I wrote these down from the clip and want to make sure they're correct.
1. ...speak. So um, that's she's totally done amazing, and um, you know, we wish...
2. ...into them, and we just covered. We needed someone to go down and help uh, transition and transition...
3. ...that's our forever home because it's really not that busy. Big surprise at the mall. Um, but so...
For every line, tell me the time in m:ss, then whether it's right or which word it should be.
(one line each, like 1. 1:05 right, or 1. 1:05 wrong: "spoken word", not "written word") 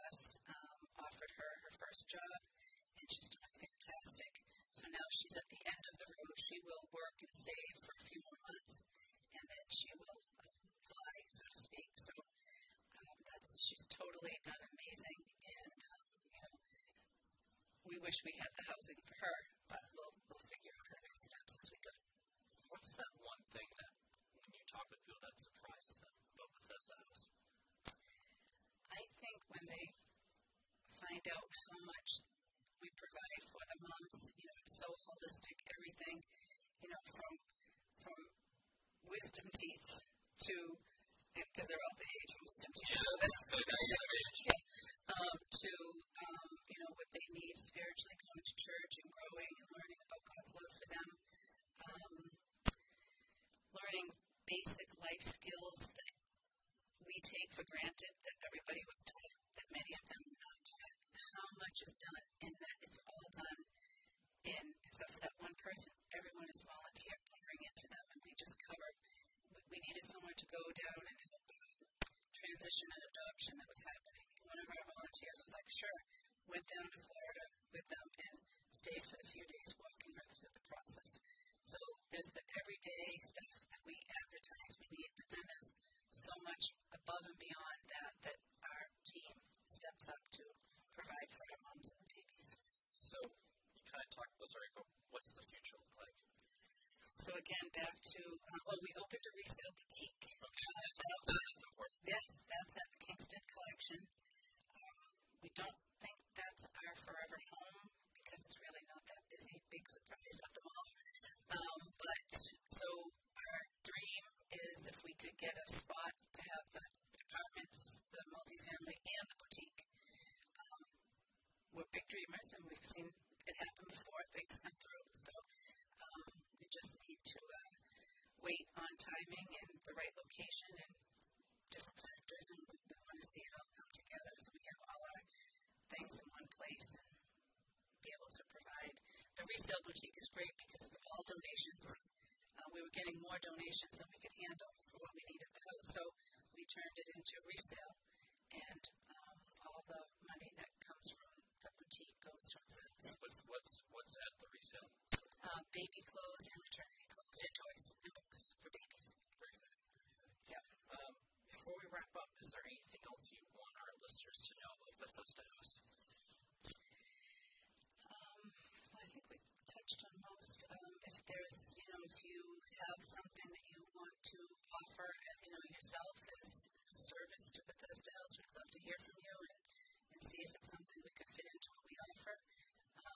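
1. 0:11 right
2. 1:07 wrong: "adoption", not "transition"
3. 1:46 right.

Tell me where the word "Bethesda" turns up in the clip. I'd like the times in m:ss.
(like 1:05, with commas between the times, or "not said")
0:26, 2:45.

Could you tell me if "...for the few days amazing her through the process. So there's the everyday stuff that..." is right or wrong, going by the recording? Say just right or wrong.
wrong.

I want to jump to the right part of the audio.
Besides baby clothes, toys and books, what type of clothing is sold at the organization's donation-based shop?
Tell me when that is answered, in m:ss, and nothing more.
2:36.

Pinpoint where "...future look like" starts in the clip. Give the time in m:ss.
1:35.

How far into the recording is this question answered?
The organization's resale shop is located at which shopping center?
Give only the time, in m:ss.
1:43.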